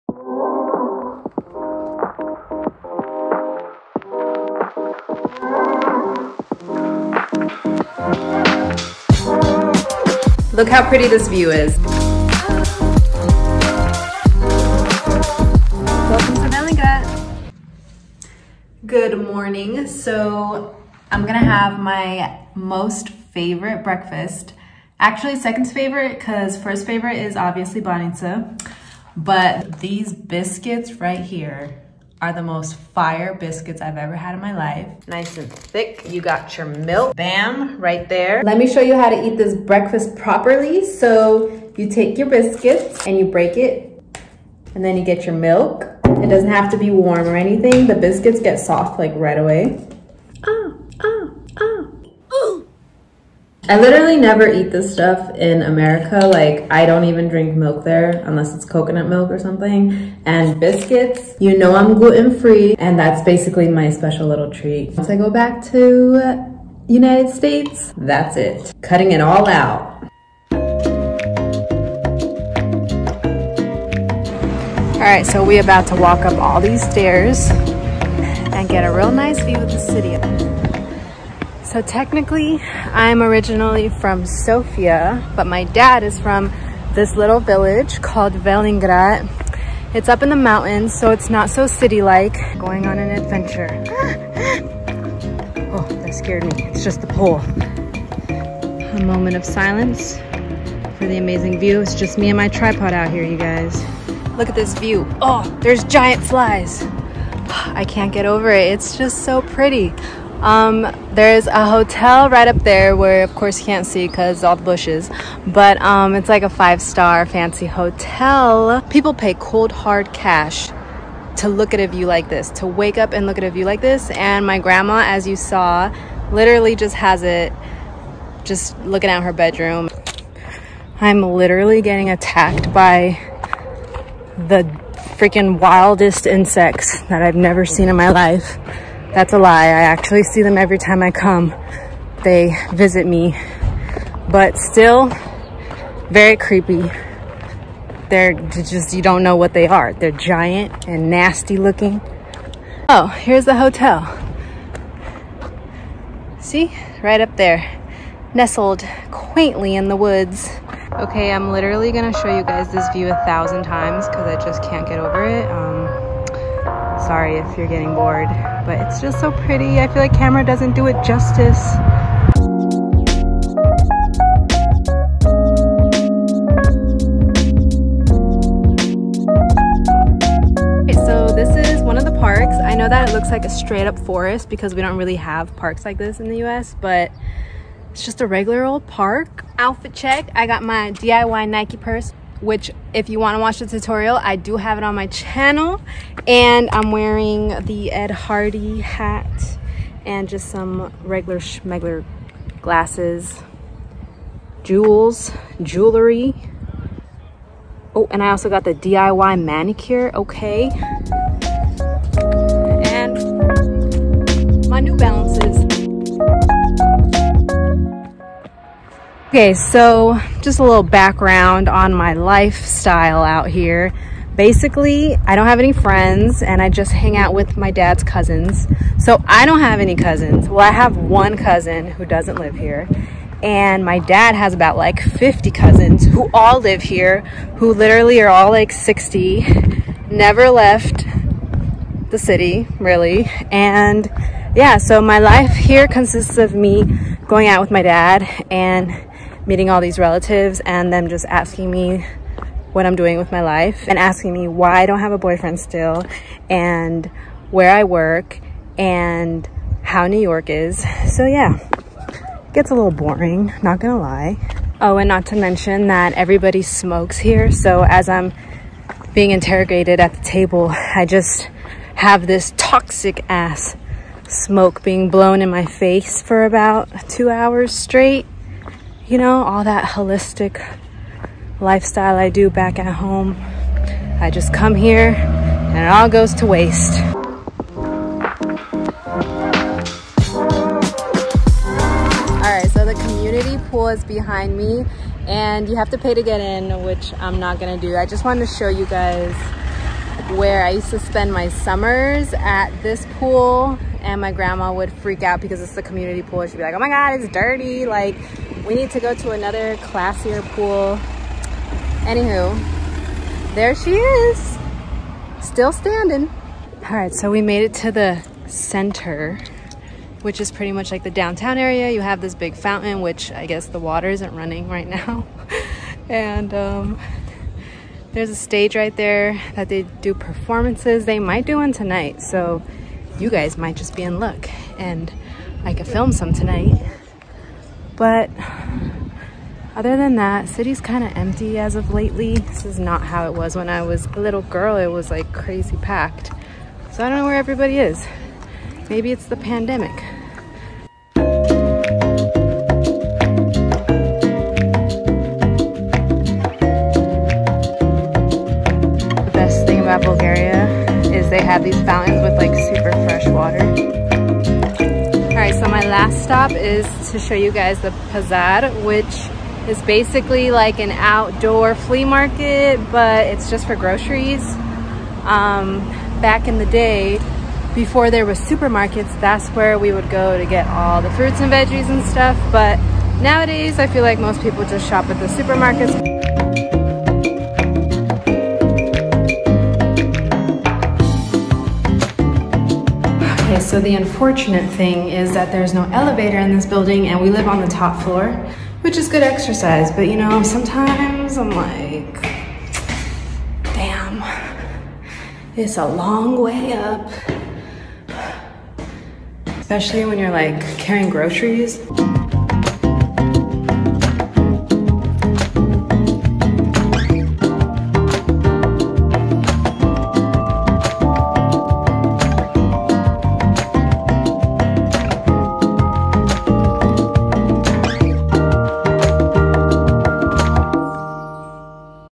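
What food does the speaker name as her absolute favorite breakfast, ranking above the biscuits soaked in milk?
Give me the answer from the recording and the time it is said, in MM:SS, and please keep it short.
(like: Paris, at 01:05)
banitsa, at 00:27.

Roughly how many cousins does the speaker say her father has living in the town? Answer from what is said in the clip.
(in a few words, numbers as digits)
50.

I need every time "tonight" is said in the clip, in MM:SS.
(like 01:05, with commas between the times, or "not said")
05:31, 05:36.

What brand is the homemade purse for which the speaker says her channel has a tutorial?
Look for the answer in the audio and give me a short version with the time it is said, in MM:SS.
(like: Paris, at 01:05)
Nike, at 03:11.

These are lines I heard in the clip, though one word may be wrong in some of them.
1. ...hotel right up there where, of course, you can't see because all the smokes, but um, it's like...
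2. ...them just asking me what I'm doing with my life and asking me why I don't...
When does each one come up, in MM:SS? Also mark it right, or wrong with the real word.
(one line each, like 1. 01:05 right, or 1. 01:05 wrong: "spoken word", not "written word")
1. 01:51 wrong: "bushes", not "smokes"
2. 04:10 right.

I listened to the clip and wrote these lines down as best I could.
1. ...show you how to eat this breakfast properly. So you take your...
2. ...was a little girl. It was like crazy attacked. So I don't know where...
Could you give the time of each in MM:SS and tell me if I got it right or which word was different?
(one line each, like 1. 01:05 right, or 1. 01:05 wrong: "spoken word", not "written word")
1. 00:38 right
2. 05:43 wrong: "packed", not "attacked".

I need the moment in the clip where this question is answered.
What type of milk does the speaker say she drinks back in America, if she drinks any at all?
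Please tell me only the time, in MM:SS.
00:58.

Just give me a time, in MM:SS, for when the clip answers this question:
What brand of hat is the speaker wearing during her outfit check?
03:17.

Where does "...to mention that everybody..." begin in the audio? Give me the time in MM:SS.
04:25.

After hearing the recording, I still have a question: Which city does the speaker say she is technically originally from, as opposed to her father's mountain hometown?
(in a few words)
Sofia.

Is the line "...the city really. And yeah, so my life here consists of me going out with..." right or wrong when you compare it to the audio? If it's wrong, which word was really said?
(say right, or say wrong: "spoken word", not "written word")
right.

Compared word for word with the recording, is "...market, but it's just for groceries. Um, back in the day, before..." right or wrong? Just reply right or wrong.
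right.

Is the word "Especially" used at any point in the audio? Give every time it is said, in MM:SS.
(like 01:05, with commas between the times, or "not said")
06:49.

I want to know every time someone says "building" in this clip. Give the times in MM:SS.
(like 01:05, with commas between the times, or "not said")
06:36.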